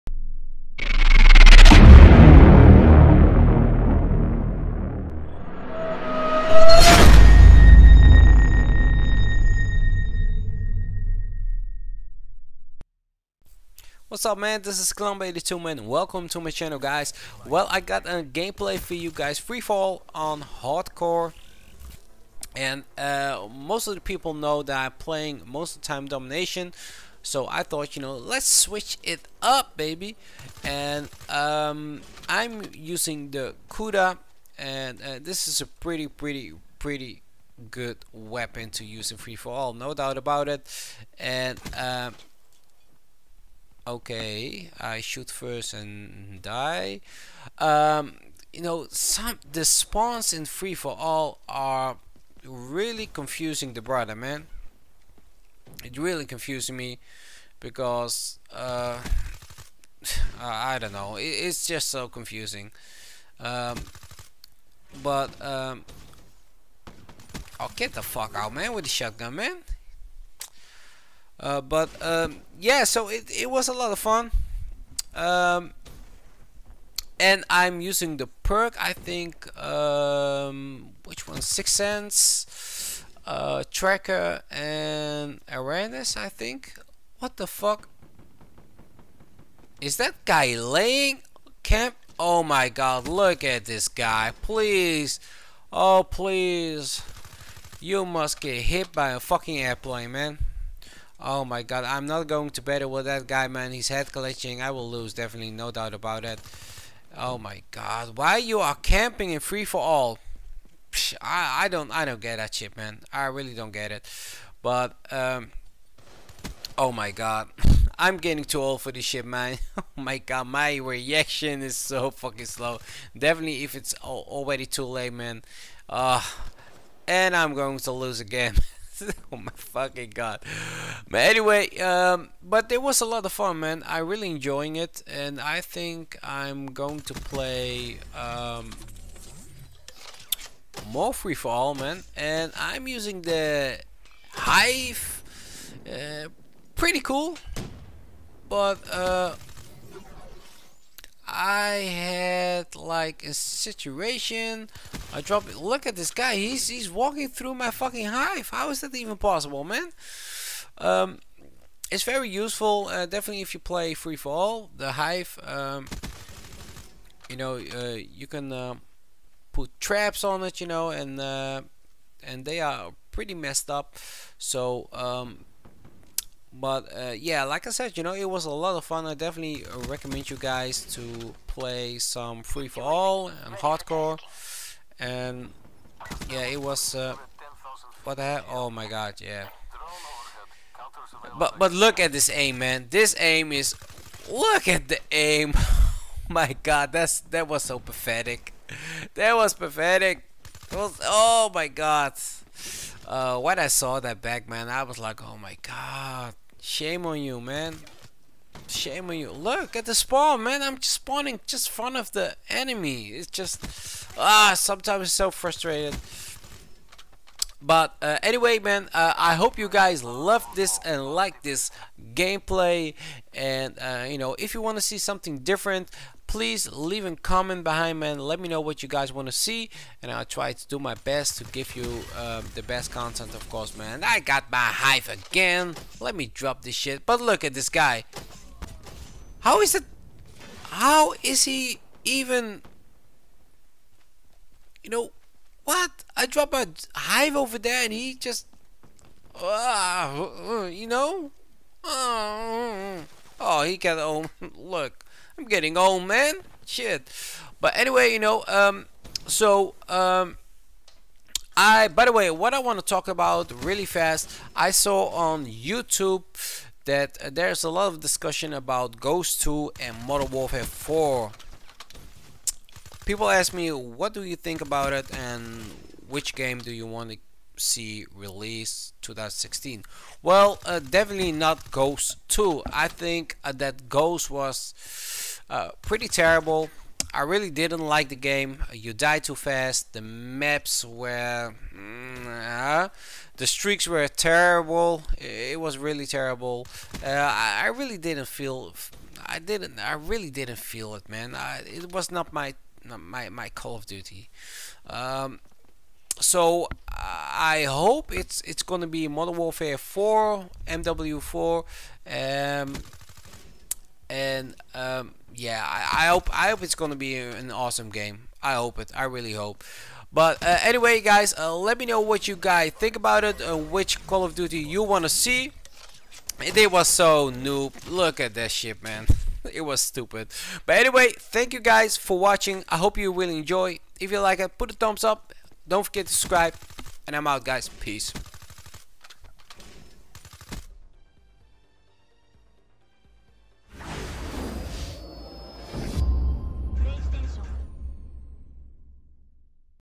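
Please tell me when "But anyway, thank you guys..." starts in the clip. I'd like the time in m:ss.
5:30.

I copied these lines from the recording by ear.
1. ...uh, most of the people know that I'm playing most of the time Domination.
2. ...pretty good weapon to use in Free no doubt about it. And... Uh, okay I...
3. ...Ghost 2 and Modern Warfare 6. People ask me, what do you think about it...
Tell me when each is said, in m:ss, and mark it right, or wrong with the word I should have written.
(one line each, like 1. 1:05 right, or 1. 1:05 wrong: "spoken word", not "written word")
1. 0:22 right
2. 0:36 right
3. 4:28 wrong: "4", not "6".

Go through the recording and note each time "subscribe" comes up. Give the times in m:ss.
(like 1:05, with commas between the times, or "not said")
5:36.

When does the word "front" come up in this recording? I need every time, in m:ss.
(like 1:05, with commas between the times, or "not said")
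3:31.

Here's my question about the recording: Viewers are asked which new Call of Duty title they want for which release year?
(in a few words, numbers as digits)
2016.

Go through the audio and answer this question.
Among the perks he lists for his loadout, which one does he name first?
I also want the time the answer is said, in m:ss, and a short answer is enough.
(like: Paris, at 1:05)
Six Sense, at 1:21.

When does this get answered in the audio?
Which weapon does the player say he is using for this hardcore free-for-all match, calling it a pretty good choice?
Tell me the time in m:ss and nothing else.
0:33.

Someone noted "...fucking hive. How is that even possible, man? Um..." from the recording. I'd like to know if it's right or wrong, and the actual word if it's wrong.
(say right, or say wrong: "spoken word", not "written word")
right.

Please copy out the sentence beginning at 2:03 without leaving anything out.
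Definitely, if it's already too late, man.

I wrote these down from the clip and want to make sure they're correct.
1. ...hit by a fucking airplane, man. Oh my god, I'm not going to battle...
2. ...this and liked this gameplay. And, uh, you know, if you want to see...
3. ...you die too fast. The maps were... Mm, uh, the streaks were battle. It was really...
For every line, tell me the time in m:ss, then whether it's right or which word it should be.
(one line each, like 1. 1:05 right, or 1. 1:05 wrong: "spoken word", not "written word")
1. 1:38 right
2. 3:40 right
3. 4:48 wrong: "terrible", not "battle".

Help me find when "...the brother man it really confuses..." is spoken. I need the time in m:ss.
0:53.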